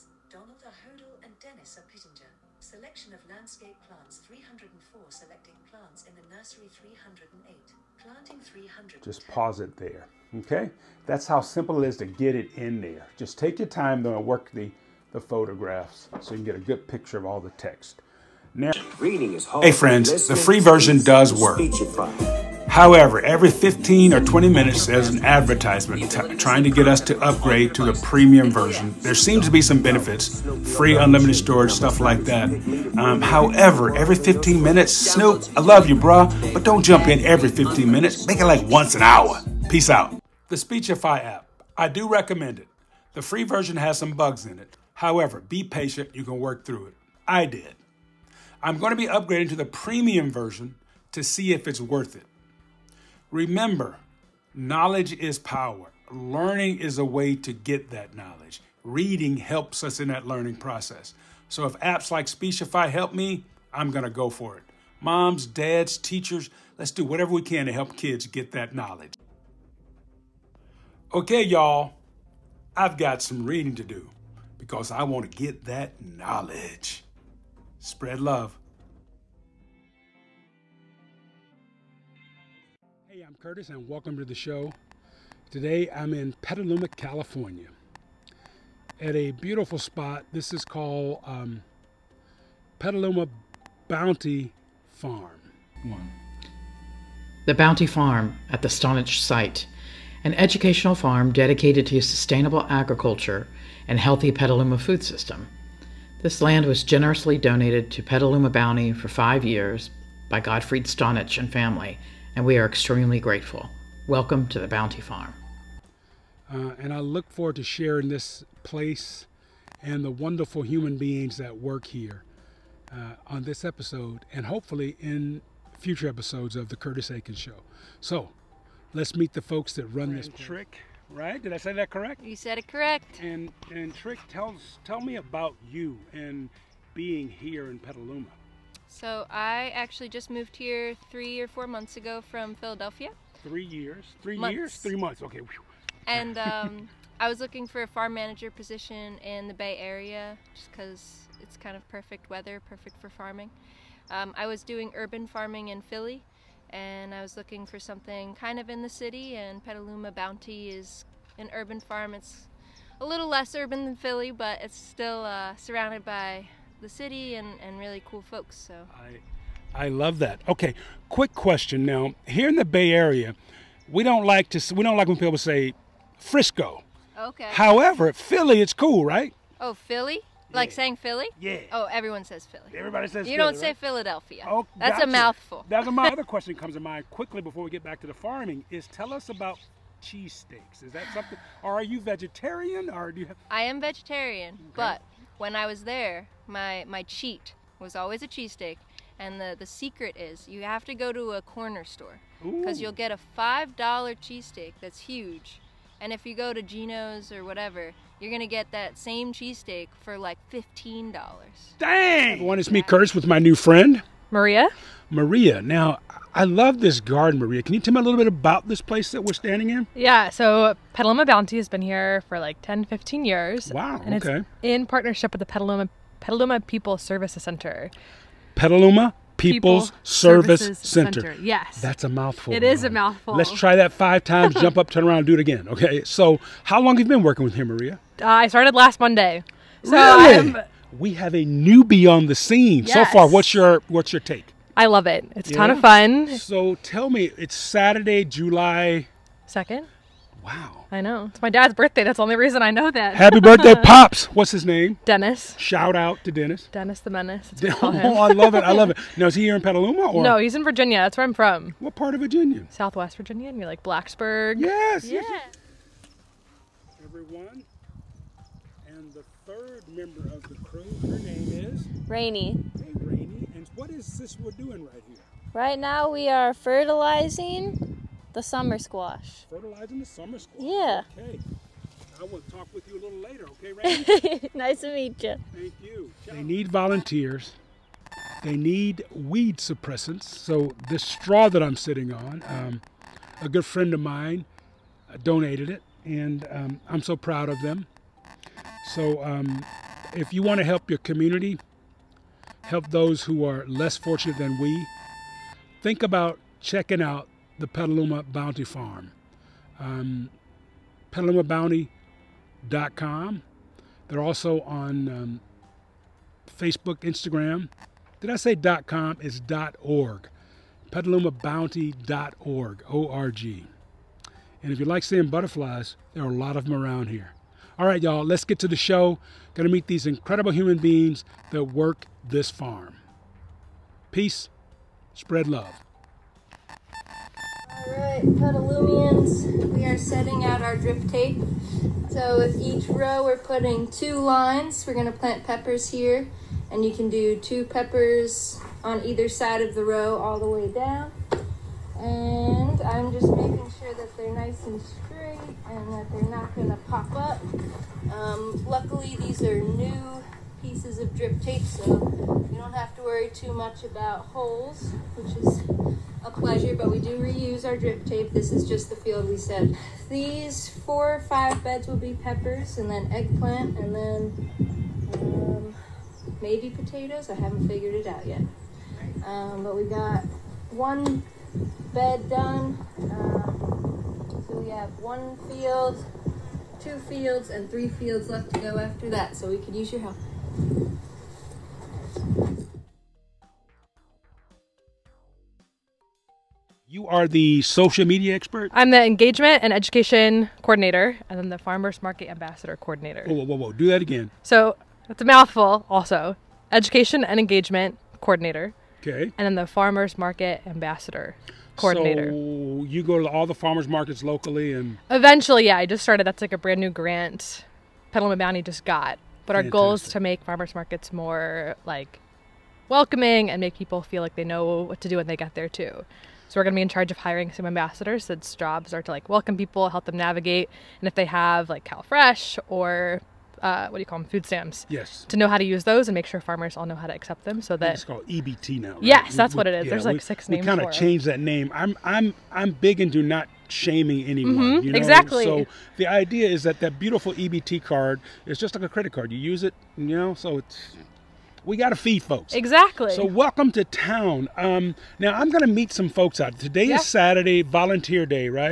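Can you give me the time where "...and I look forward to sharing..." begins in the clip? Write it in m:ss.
1:56.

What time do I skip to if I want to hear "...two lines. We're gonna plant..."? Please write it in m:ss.
5:43.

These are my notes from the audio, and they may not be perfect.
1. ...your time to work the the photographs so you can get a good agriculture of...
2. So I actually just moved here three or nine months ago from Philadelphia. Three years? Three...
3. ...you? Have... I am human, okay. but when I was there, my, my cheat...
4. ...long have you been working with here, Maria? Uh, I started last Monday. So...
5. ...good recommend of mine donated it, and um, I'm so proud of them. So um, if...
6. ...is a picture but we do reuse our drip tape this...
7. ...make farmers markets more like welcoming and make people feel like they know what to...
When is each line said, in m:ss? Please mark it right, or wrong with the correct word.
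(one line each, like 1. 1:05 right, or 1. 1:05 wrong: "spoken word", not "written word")
1. 0:13 wrong: "picture", not "agriculture"
2. 2:18 wrong: "four", not "nine"
3. 3:13 wrong: "vegetarian", not "human"
4. 3:56 right
5. 4:53 wrong: "friend", not "recommend"
6. 6:05 wrong: "pleasure", not "picture"
7. 7:00 right.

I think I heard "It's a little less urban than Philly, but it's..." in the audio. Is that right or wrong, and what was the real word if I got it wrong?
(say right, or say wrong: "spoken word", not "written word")
right.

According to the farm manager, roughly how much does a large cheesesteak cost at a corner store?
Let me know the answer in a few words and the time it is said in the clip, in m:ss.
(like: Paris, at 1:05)
$5, at 3:23.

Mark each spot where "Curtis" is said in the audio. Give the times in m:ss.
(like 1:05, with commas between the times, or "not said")
1:23, 2:06, 3:32.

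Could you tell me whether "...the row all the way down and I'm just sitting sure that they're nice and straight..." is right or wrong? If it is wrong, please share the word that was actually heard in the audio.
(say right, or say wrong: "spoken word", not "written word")
wrong: "making", not "sitting".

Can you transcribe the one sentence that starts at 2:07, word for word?
So let's meet the folks that run this.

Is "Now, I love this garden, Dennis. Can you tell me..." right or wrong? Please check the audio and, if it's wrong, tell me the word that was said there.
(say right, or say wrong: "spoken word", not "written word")
wrong: "Maria", not "Dennis".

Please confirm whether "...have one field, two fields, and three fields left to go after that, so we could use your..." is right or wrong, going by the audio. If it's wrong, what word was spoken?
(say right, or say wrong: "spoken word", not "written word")
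right.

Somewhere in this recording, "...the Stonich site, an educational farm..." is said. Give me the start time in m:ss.
1:38.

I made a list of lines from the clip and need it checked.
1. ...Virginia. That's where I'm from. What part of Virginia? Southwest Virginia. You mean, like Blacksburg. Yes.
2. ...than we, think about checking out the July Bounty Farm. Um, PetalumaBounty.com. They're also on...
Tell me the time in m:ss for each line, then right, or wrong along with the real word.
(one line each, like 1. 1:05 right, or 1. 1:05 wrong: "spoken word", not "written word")
1. 4:20 right
2. 5:04 wrong: "Petaluma", not "July".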